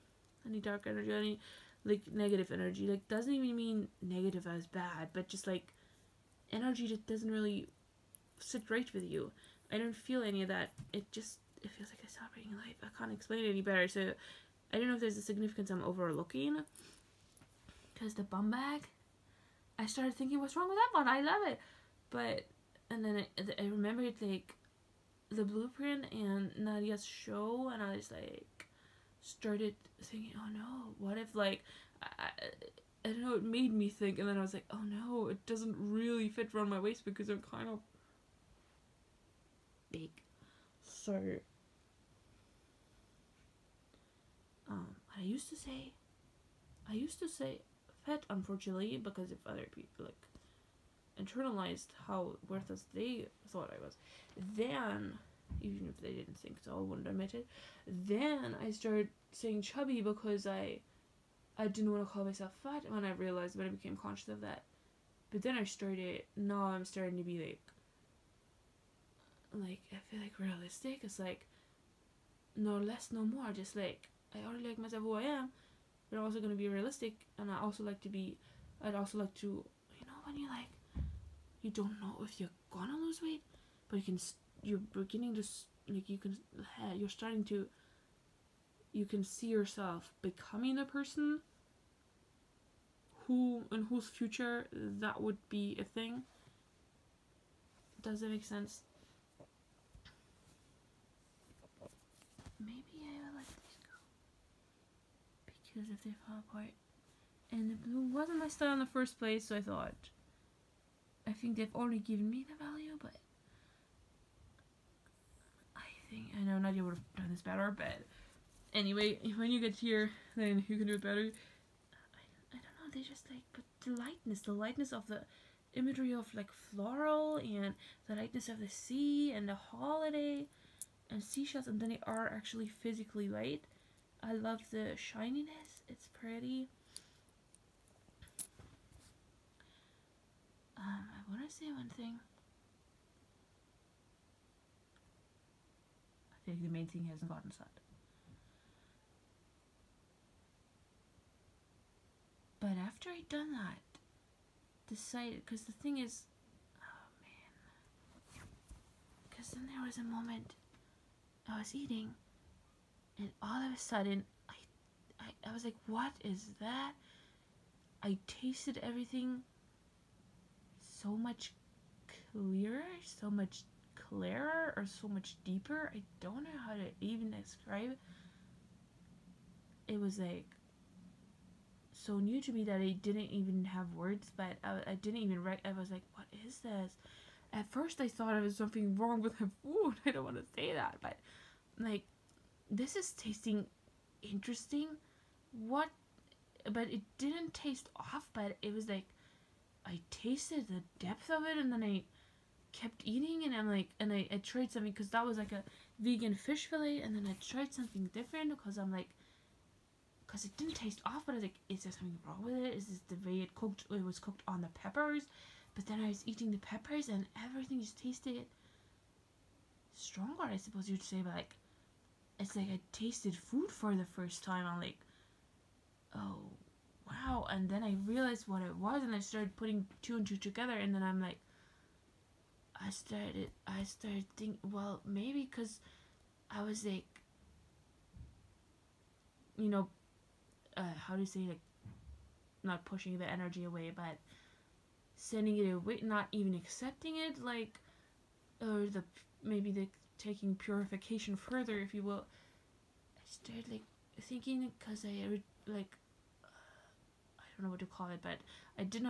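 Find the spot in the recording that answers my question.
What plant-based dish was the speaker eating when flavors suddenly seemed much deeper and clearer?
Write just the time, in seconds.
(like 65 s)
205 s.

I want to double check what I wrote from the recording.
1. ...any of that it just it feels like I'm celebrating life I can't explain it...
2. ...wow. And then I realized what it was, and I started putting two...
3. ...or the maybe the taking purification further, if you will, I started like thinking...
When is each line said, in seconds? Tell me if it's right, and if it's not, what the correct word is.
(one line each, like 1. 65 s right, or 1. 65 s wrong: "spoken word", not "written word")
1. 10 s right
2. 227 s right
3. 248 s right.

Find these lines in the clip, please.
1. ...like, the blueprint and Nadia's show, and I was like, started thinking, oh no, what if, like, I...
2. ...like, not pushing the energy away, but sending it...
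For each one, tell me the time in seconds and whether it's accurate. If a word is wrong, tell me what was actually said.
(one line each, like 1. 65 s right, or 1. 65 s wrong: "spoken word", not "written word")
1. 24 s right
2. 241 s right.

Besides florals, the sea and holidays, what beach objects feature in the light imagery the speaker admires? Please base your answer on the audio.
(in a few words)
seashells.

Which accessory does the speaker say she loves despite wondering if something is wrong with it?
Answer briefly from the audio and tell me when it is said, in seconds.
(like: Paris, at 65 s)
bum bag, at 18 s.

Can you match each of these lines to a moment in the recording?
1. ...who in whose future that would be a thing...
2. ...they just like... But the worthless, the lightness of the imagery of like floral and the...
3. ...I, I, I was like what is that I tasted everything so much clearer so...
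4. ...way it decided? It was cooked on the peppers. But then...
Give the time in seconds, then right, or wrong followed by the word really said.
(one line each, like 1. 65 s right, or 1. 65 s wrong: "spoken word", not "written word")
1. 93 s right
2. 122 s wrong: "lightness", not "worthless"
3. 164 s right
4. 213 s wrong: "cooked", not "decided".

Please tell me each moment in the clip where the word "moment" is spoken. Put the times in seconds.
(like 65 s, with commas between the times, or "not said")
160 s.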